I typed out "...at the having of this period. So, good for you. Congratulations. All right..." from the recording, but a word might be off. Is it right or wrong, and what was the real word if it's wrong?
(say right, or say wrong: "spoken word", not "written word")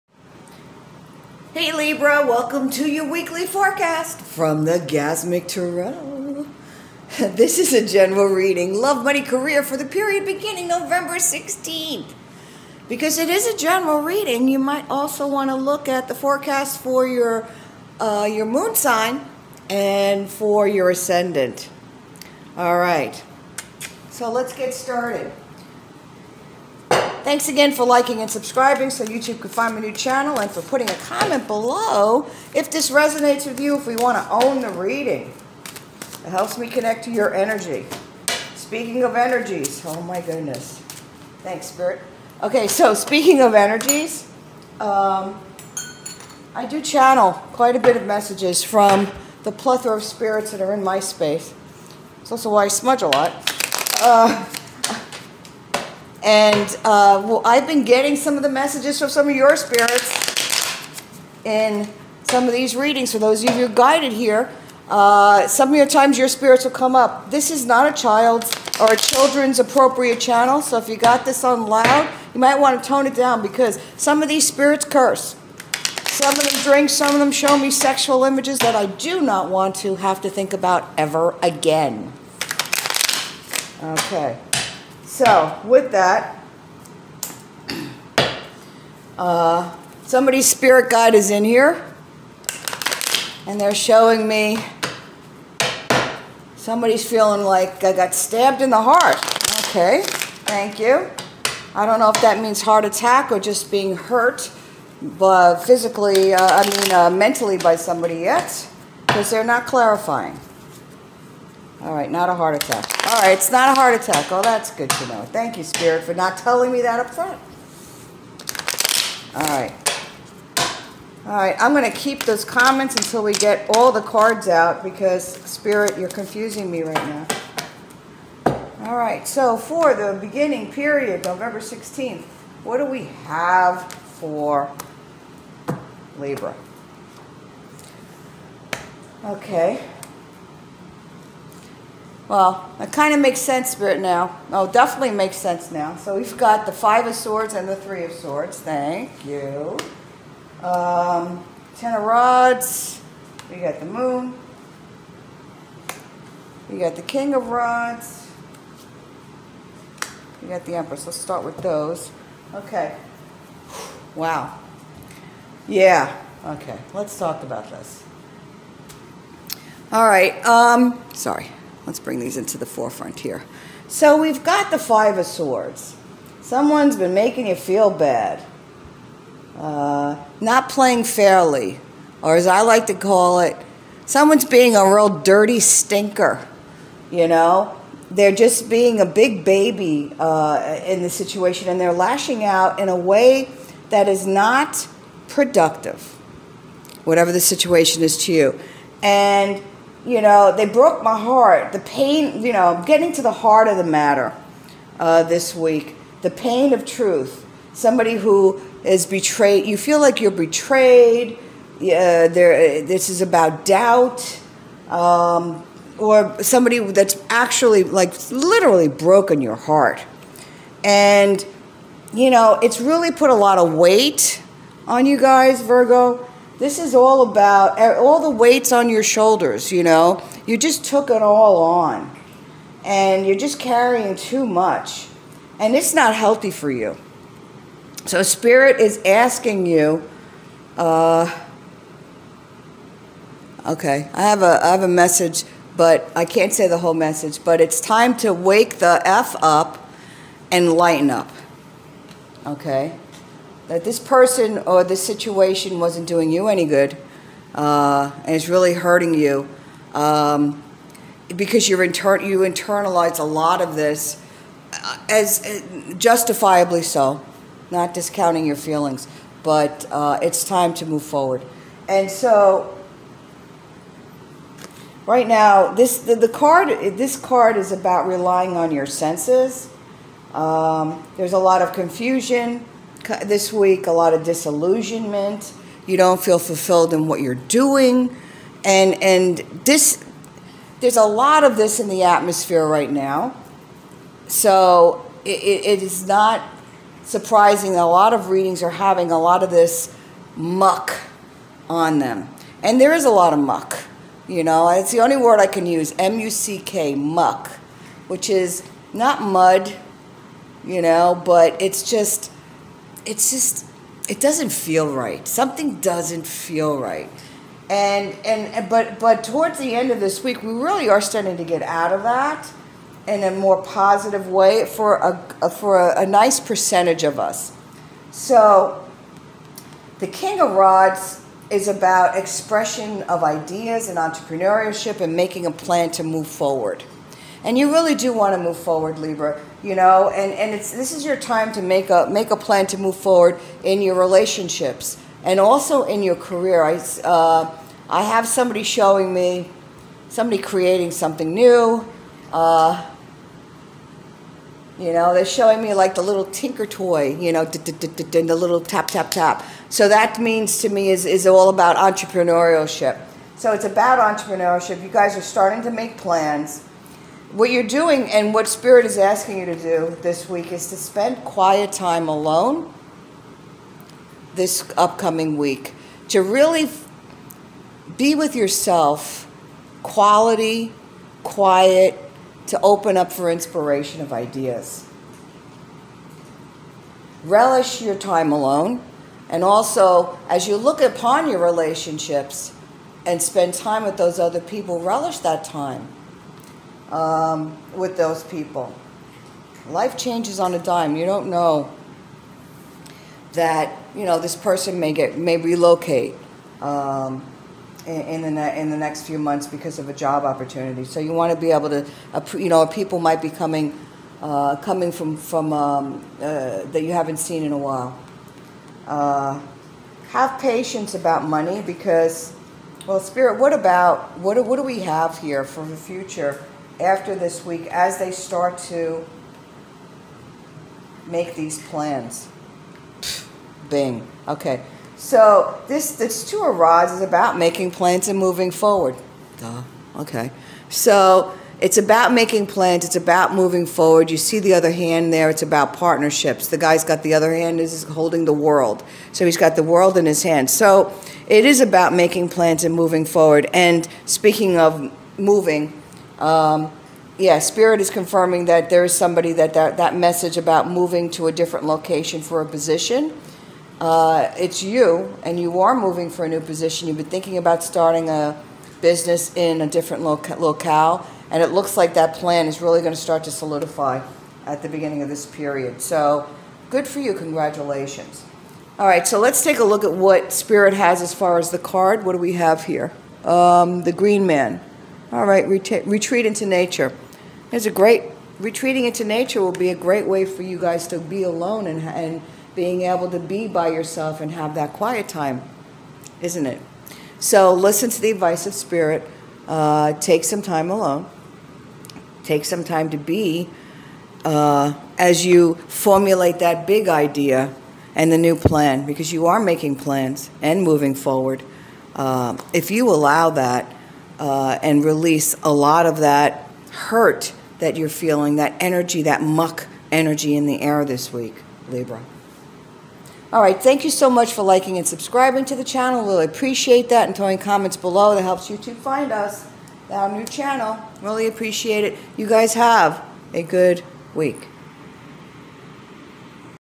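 wrong: "beginning", not "having".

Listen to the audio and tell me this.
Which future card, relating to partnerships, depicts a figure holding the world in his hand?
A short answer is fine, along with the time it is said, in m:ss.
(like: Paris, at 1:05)
Two of Rods, at 7:16.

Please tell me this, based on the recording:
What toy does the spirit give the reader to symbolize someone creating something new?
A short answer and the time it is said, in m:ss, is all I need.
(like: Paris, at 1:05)
Tinker toy, at 5:56.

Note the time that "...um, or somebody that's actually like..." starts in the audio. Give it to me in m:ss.
3:34.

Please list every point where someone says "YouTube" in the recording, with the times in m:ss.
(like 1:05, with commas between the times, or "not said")
0:29, 8:48.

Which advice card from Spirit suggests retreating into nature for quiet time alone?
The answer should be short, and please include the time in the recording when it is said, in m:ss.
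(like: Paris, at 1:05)
The Green Man, at 8:03.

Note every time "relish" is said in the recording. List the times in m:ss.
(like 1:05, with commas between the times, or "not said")
6:27, 6:34.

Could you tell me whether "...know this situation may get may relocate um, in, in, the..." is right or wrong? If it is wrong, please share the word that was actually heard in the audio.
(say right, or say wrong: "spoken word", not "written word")
wrong: "person", not "situation".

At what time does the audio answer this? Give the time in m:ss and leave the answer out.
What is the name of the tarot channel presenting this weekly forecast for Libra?
0:04.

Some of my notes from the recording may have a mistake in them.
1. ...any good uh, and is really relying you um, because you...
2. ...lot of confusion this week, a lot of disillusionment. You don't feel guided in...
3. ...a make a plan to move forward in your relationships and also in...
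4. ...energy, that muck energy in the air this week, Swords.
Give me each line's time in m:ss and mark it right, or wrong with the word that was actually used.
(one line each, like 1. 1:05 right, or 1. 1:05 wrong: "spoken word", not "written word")
1. 4:16 wrong: "hurting", not "relying"
2. 4:41 wrong: "fulfilled", not "guided"
3. 5:41 right
4. 8:38 wrong: "Libra", not "Swords".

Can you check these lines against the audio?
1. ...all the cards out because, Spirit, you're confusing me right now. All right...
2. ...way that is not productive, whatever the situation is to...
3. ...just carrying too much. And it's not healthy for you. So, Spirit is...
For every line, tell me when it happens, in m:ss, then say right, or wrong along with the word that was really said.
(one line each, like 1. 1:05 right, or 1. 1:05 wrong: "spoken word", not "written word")
1. 2:03 right
2. 3:12 right
3. 3:53 right.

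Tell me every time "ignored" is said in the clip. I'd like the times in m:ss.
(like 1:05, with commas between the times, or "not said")
not said.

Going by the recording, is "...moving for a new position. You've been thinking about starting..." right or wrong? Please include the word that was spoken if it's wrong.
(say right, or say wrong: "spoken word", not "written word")
right.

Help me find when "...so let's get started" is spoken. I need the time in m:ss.
0:24.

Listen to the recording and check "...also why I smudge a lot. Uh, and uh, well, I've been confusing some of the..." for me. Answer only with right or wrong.
wrong.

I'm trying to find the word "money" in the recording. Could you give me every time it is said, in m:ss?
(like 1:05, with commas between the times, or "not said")
0:09, 7:01.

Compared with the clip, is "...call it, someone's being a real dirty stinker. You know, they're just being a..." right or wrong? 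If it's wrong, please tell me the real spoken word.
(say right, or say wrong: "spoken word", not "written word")
right.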